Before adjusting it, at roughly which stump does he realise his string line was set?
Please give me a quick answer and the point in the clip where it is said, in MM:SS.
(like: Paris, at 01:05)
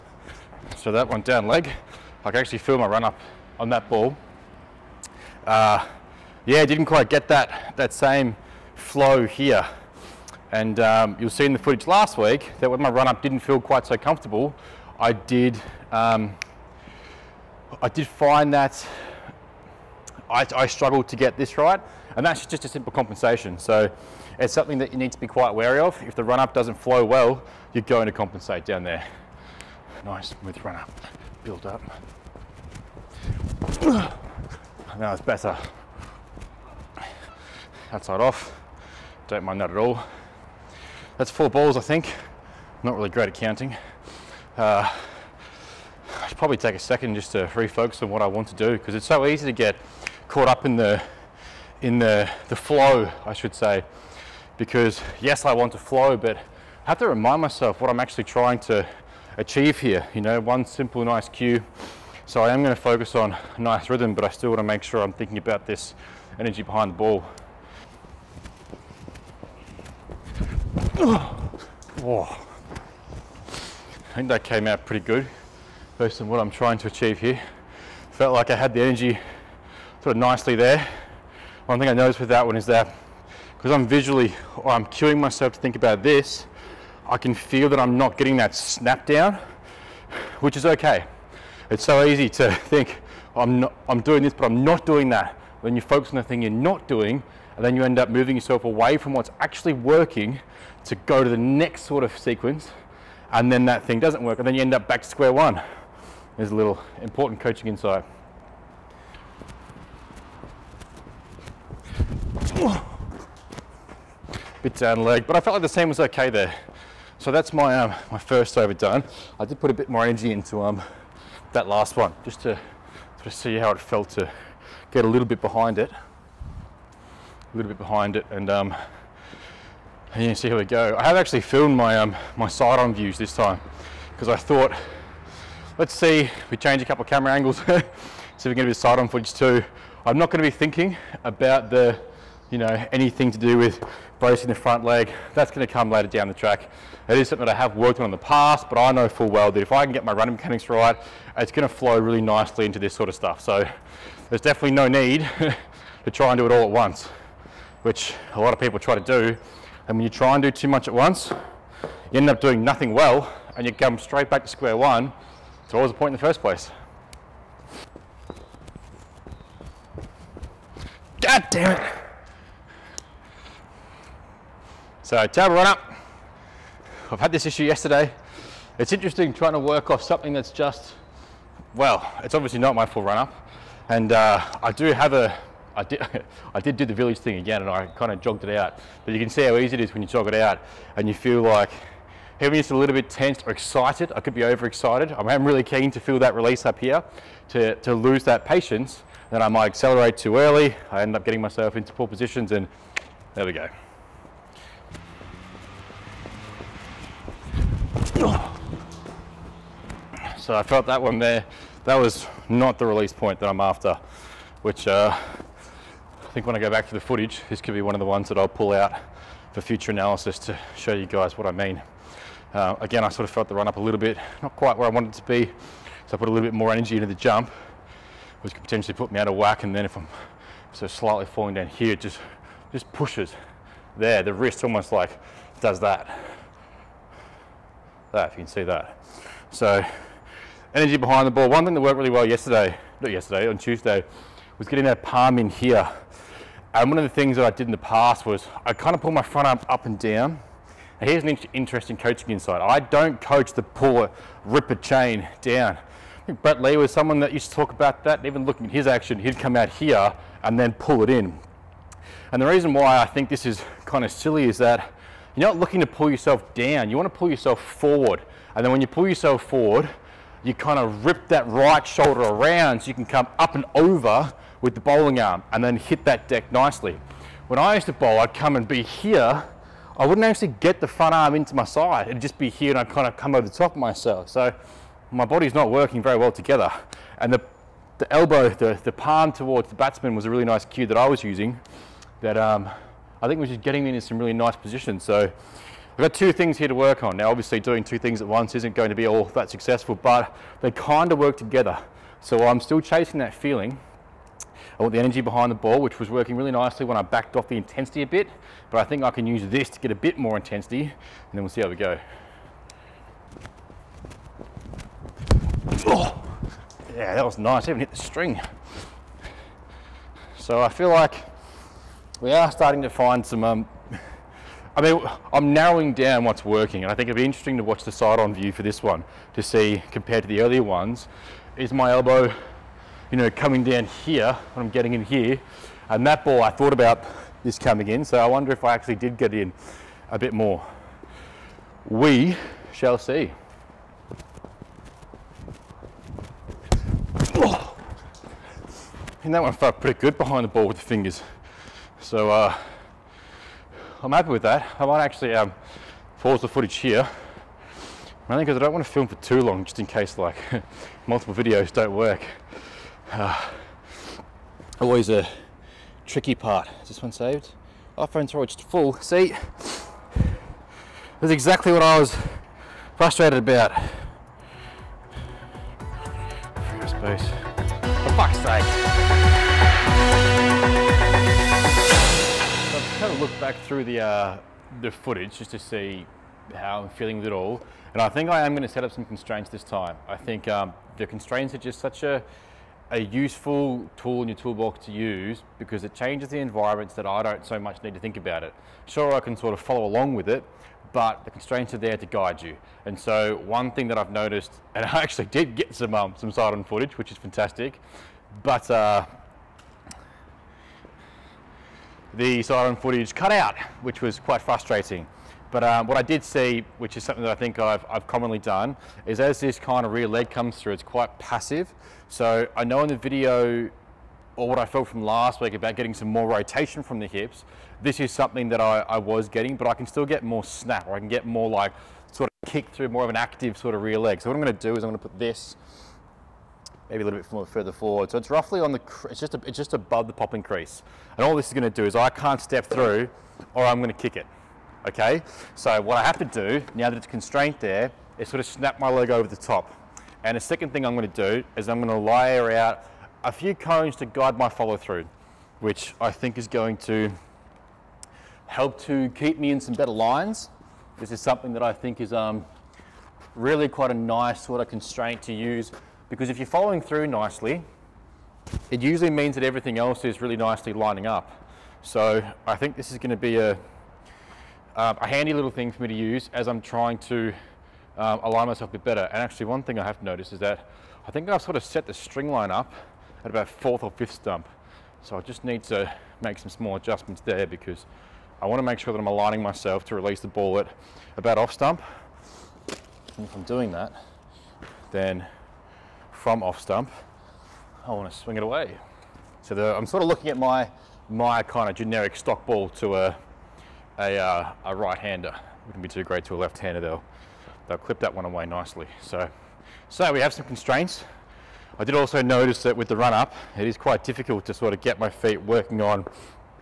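fourth or fifth stump, at 08:03.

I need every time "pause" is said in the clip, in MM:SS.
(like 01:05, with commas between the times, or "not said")
05:56.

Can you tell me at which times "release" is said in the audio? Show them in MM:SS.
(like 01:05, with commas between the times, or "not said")
03:16, 03:32, 08:09.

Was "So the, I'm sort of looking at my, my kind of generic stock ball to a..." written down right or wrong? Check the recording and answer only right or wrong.
right.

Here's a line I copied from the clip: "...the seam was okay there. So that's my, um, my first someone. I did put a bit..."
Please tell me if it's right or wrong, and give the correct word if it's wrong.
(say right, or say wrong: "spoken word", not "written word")
wrong: "overdone", not "someone".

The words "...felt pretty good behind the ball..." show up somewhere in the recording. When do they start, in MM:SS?
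05:49.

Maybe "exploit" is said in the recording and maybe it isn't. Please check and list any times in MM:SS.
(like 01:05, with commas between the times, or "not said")
not said.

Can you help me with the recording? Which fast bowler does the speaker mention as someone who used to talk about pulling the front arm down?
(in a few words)
Brett Lee.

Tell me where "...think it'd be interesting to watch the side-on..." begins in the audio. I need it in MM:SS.
05:26.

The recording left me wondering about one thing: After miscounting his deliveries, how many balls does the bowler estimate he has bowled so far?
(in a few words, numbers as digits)
4.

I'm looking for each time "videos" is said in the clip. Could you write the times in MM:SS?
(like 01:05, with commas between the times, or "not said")
06:01, 07:02.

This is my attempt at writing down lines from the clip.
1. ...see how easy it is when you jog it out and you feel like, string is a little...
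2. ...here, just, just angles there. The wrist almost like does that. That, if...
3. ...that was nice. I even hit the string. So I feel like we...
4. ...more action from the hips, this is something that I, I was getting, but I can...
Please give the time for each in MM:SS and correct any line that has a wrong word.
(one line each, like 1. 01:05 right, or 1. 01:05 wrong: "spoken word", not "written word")
1. 03:09 wrong: "having", not "string"
2. 03:51 wrong: "pushes", not "angles"
3. 05:17 right
4. 07:06 wrong: "rotation", not "action".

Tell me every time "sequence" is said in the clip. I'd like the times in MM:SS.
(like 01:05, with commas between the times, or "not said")
01:42.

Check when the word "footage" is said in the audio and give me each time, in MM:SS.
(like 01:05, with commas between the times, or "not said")
00:11, 02:19, 03:36, 05:56, 06:24, 06:46, 06:52.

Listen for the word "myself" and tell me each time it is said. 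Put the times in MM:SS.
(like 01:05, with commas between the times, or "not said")
00:57, 01:25, 03:21, 04:43, 07:58, 08:09.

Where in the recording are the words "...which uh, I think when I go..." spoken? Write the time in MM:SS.
03:34.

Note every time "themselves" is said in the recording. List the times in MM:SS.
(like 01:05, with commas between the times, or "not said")
not said.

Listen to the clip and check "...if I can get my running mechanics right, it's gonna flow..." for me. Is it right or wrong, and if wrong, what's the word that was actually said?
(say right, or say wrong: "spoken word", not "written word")
right.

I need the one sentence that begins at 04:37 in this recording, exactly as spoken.
When I used to bowl, I'd come and be here.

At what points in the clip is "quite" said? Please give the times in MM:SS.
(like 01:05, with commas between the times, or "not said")
00:06, 00:13, 00:25, 03:44, 06:54, 07:00, 07:43, 08:33.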